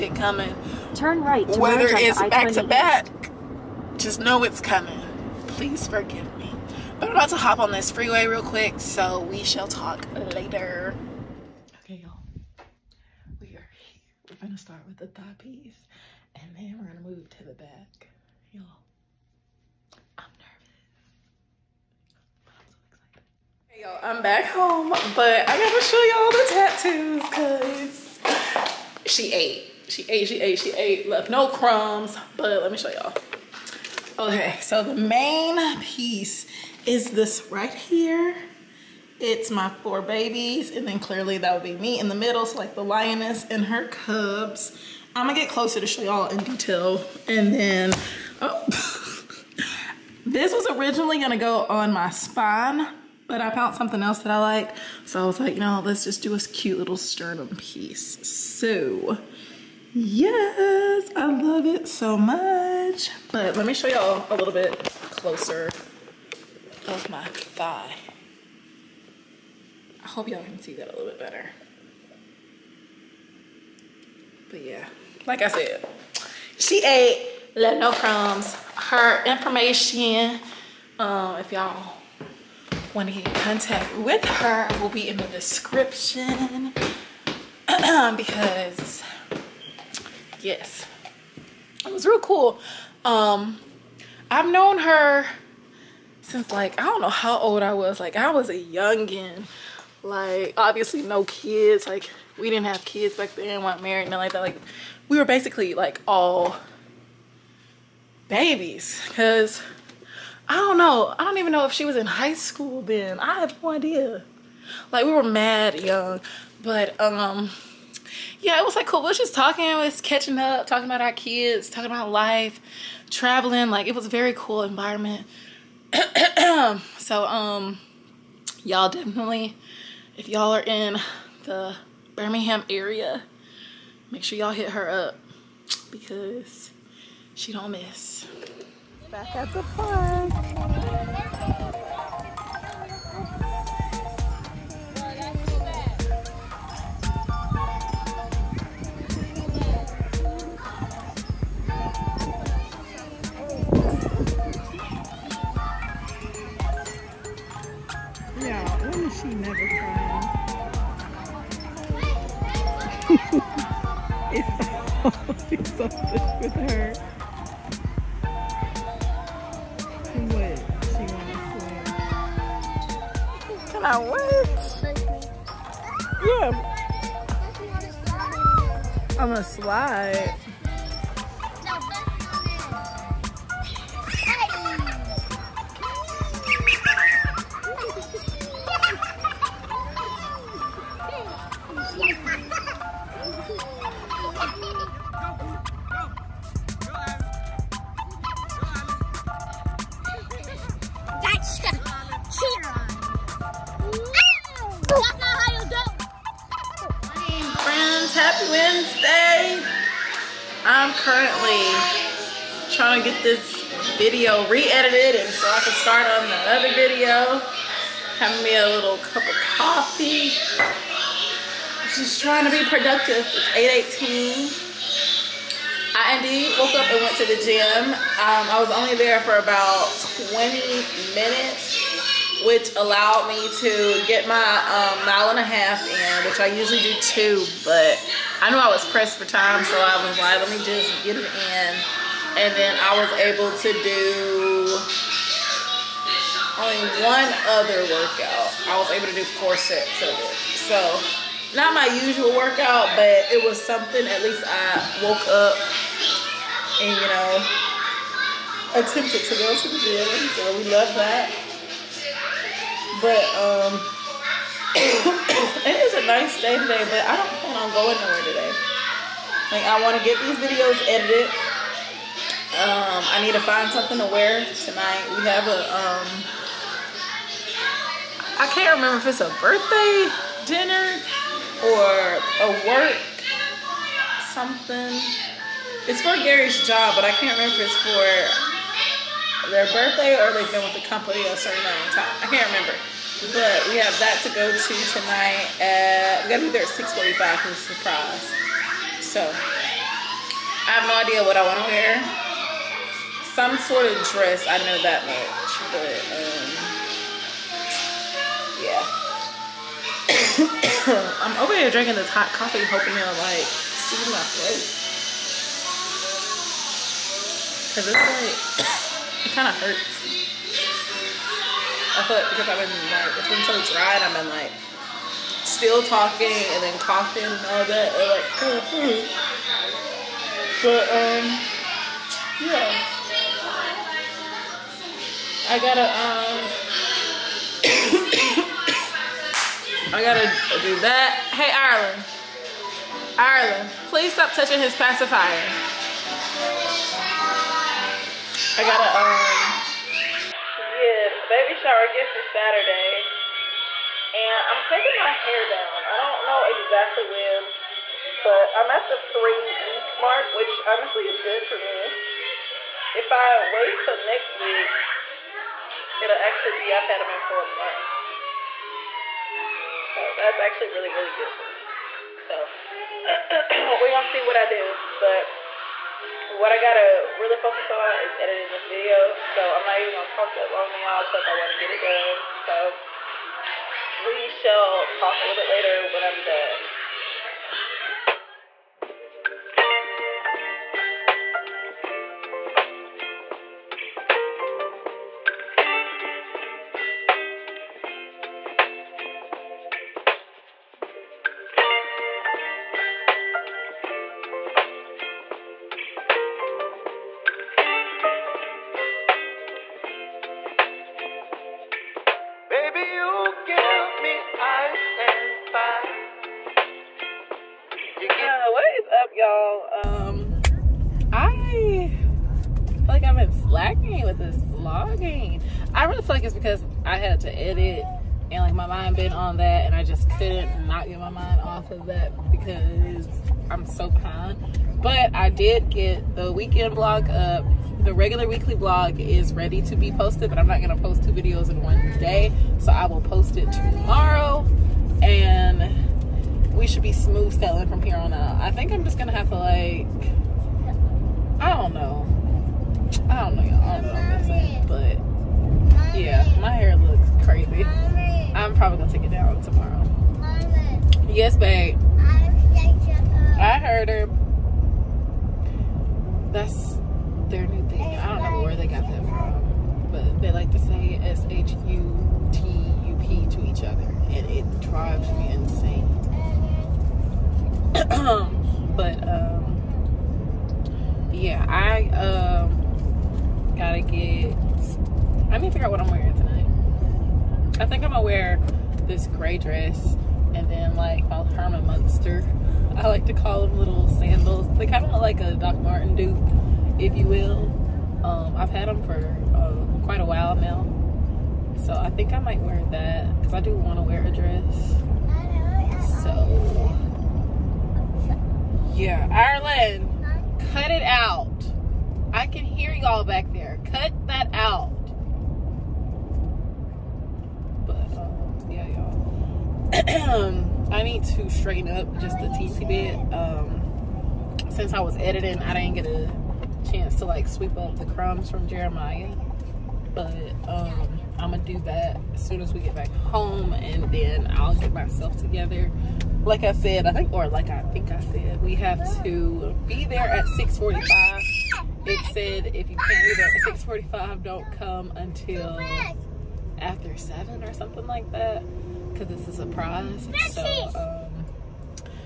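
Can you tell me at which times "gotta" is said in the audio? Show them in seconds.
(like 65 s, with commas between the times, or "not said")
26 s, 296 s, 335 s, 340 s, 376 s, 483 s.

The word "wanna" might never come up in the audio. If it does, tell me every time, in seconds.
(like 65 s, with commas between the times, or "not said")
269 s, 381 s.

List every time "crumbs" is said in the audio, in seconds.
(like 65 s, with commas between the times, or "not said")
31 s, 77 s, 527 s.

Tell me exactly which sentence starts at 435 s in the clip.
that, I did get the weekend blog up.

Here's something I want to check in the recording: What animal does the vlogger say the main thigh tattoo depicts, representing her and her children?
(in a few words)
lioness and her cubs.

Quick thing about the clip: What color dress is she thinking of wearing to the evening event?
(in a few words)
gray.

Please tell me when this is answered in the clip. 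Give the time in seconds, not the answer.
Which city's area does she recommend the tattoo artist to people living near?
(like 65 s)
132 s.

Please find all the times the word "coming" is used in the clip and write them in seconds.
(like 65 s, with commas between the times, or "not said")
0 s, 4 s.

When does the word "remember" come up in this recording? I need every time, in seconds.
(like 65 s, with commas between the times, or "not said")
278 s, 287 s, 292 s.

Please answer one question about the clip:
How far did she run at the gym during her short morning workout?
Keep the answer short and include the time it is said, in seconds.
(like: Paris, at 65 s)
mile and a half, at 235 s.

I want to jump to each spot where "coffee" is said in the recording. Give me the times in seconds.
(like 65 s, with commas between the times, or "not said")
219 s, 312 s.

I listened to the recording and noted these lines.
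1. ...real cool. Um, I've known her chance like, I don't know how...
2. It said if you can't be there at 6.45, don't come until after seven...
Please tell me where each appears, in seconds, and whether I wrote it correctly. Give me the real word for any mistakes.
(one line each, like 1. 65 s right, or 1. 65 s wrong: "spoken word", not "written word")
1. 92 s wrong: "since", not "chance"
2. 541 s right.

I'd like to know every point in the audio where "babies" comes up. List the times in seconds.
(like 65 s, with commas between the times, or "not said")
40 s, 108 s.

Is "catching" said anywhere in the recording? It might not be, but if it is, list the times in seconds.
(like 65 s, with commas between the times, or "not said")
120 s.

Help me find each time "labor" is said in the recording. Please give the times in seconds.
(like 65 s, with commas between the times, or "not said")
not said.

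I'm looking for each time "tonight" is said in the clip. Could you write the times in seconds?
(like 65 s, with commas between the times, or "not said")
274 s, 294 s, 486 s.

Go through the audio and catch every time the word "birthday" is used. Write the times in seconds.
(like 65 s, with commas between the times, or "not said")
279 s, 289 s.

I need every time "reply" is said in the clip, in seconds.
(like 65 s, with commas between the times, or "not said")
not said.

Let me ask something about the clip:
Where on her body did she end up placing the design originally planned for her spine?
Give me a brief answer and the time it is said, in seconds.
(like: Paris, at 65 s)
sternum, at 56 s.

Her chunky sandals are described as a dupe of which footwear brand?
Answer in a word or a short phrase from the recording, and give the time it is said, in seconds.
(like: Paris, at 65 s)
Doc Martin, at 495 s.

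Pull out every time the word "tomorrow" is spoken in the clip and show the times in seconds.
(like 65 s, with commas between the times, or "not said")
443 s, 459 s.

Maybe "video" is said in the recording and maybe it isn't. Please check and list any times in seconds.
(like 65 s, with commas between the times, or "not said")
216 s, 270 s, 378 s, 441 s.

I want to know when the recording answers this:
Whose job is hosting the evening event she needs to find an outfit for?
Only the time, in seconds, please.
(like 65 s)
286 s.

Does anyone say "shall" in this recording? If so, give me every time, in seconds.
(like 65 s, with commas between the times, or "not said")
9 s, 384 s.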